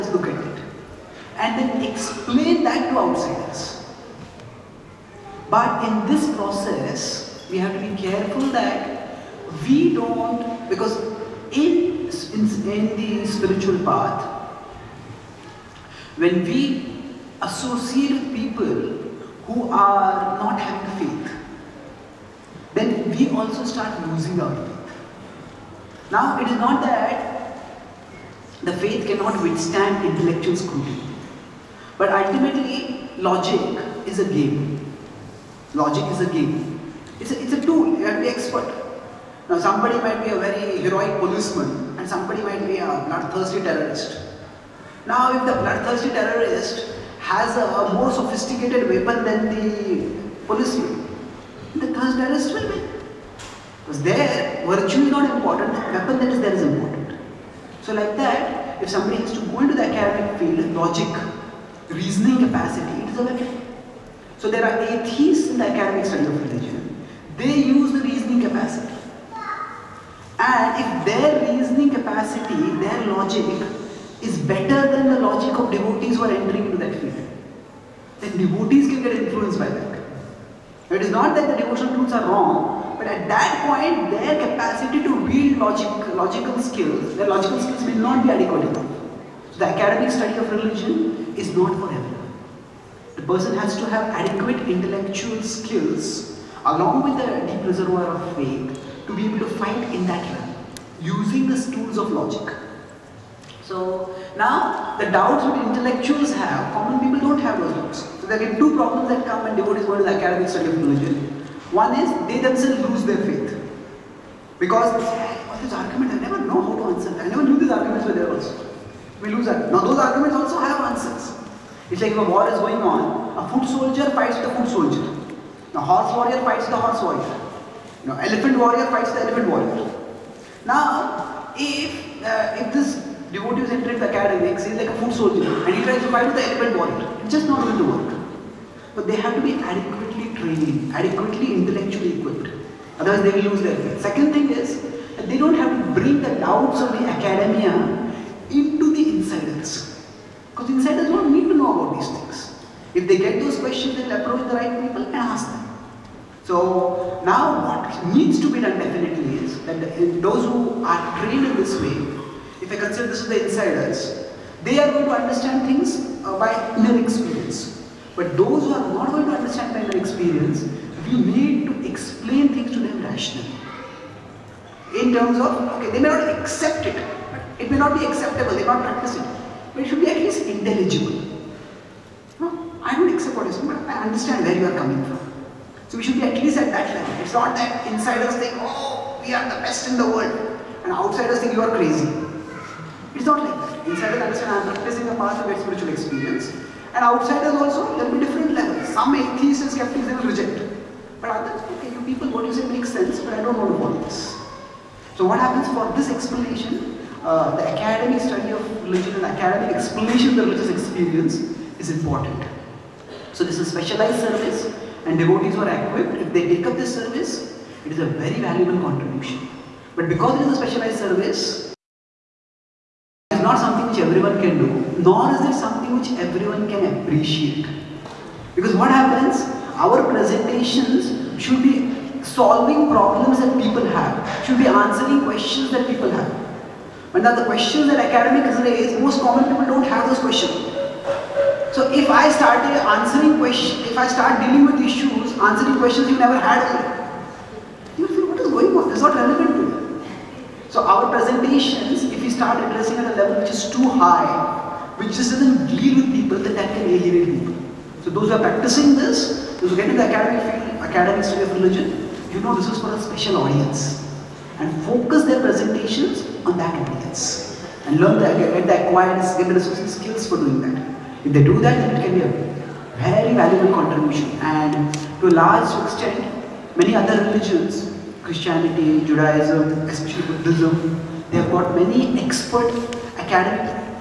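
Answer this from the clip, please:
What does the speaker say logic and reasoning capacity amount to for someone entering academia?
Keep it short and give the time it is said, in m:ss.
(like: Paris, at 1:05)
a weapon, at 1:03.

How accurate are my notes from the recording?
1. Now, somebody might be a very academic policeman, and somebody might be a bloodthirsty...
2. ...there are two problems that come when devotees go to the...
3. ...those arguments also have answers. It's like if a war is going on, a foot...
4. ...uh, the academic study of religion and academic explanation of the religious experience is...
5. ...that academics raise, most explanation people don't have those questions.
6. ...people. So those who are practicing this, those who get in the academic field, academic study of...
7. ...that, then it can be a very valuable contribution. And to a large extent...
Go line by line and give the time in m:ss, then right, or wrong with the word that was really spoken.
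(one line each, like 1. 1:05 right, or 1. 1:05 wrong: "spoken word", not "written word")
1. 0:39 wrong: "heroic", not "academic"
2. 1:48 right
3. 1:59 right
4. 3:27 right
5. 3:57 wrong: "common", not "explanation"
6. 4:17 right
7. 4:31 right.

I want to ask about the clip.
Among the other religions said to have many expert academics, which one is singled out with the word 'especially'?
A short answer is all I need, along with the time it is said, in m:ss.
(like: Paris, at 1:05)
Buddhism, at 4:40.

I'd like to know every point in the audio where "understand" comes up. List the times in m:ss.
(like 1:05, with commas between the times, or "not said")
2:45, 2:49, 3:04, 3:14.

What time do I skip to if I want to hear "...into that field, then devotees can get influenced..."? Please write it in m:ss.
1:16.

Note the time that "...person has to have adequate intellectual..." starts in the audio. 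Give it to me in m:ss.
1:33.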